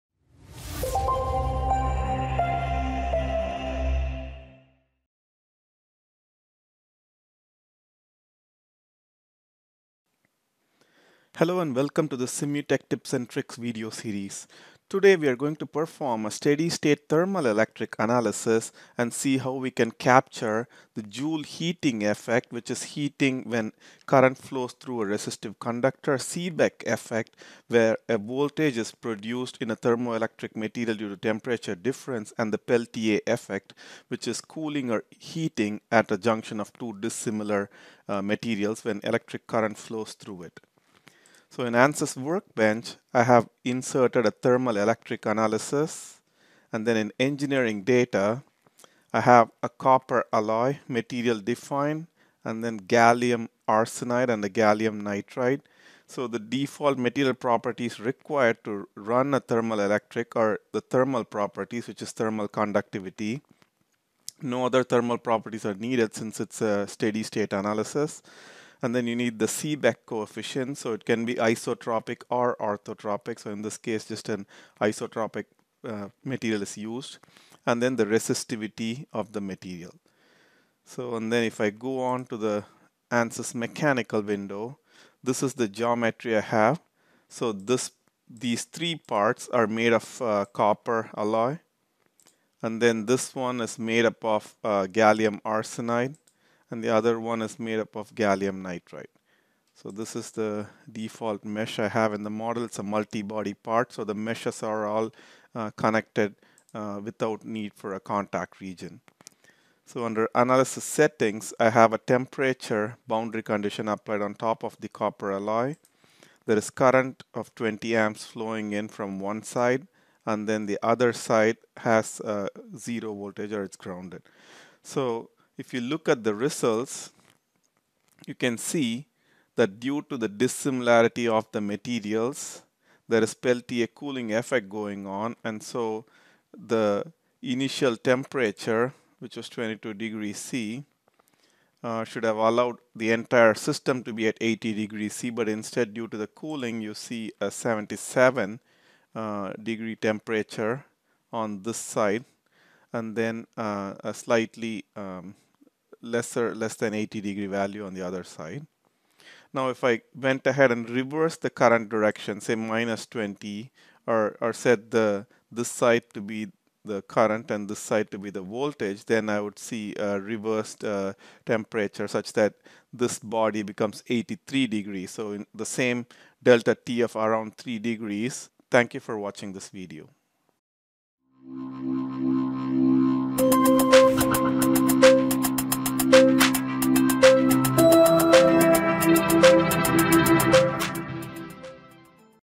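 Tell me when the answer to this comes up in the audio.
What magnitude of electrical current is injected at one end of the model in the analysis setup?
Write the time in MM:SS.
01:57.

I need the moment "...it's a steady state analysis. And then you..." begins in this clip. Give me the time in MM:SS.
01:06.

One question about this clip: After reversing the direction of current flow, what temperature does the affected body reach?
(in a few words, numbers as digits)
83 degrees.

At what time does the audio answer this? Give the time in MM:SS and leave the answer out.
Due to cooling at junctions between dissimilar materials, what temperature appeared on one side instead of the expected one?
02:27.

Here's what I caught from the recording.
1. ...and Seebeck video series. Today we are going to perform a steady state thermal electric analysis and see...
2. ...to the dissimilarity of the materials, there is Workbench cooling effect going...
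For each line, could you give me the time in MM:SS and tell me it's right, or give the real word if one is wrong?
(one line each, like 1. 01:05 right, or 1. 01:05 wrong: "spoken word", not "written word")
1. 00:13 wrong: "Tricks", not "Seebeck"
2. 02:10 wrong: "Peltier", not "Workbench".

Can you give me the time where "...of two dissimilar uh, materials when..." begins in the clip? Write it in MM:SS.
00:36.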